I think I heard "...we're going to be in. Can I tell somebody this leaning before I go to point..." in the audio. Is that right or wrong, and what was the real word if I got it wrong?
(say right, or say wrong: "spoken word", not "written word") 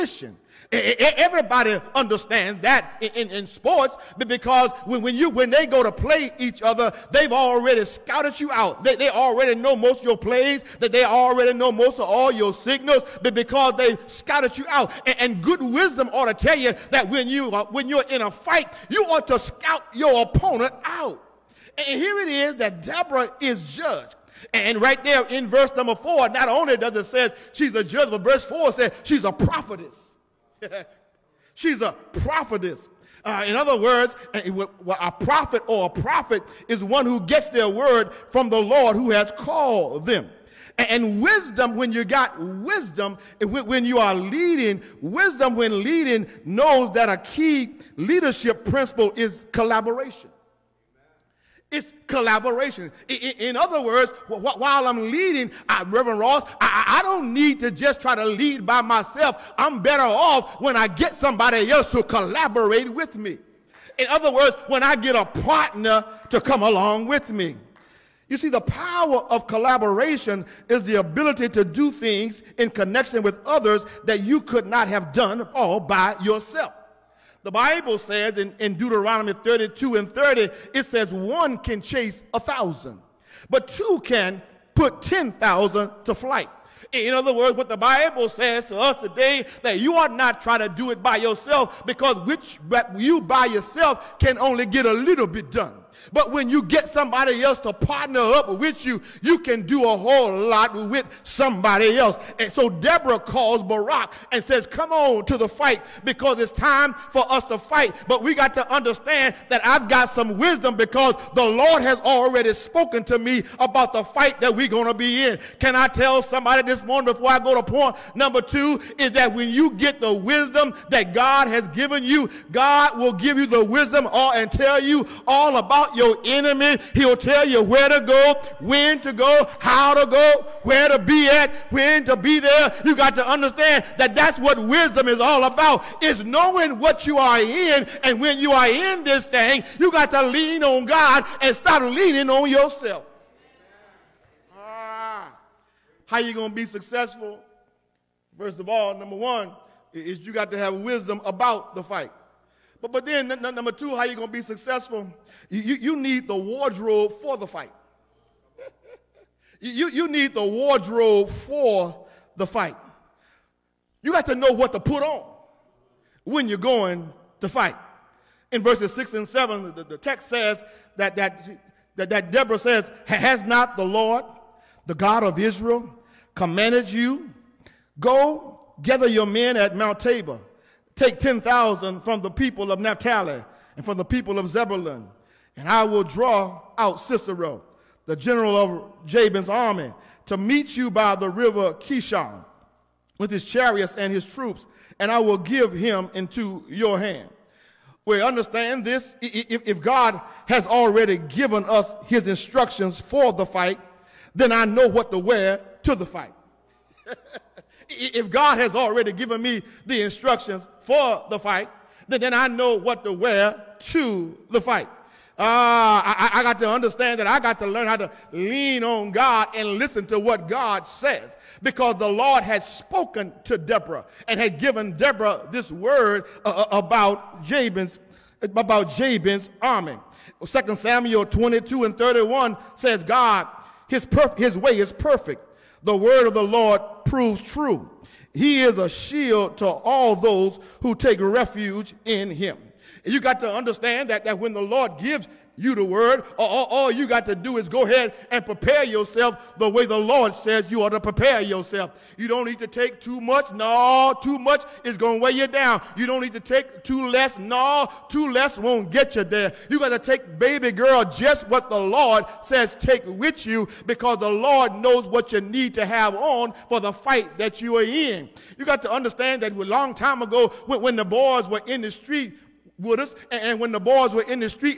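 wrong: "morning", not "leaning".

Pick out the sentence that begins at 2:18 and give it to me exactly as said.
And when you are in this thing, you got to lean on God and stop leaning on yourself.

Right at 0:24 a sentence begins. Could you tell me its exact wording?
And right there in verse number four, not only does it say she's a judge, but verse four says she's a prophetess.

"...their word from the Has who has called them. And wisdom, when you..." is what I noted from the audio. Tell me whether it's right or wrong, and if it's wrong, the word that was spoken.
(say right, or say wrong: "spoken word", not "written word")
wrong: "Lord", not "Has".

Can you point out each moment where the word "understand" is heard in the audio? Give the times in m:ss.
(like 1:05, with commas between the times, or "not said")
0:01, 1:48, 2:13, 3:18, 3:36, 4:03, 4:28.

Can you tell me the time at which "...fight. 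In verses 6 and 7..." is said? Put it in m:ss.
2:47.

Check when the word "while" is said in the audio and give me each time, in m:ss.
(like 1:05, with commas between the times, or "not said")
0:54.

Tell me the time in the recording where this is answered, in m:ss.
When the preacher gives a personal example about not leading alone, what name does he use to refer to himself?
0:55.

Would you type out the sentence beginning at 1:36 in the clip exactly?
But when you get somebody else to partner up with you, you can do a whole lot with somebody else.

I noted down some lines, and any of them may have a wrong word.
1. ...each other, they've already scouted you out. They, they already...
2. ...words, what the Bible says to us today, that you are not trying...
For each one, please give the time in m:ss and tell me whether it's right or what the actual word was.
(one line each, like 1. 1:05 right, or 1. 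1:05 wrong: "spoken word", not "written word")
1. 0:06 right
2. 1:27 right.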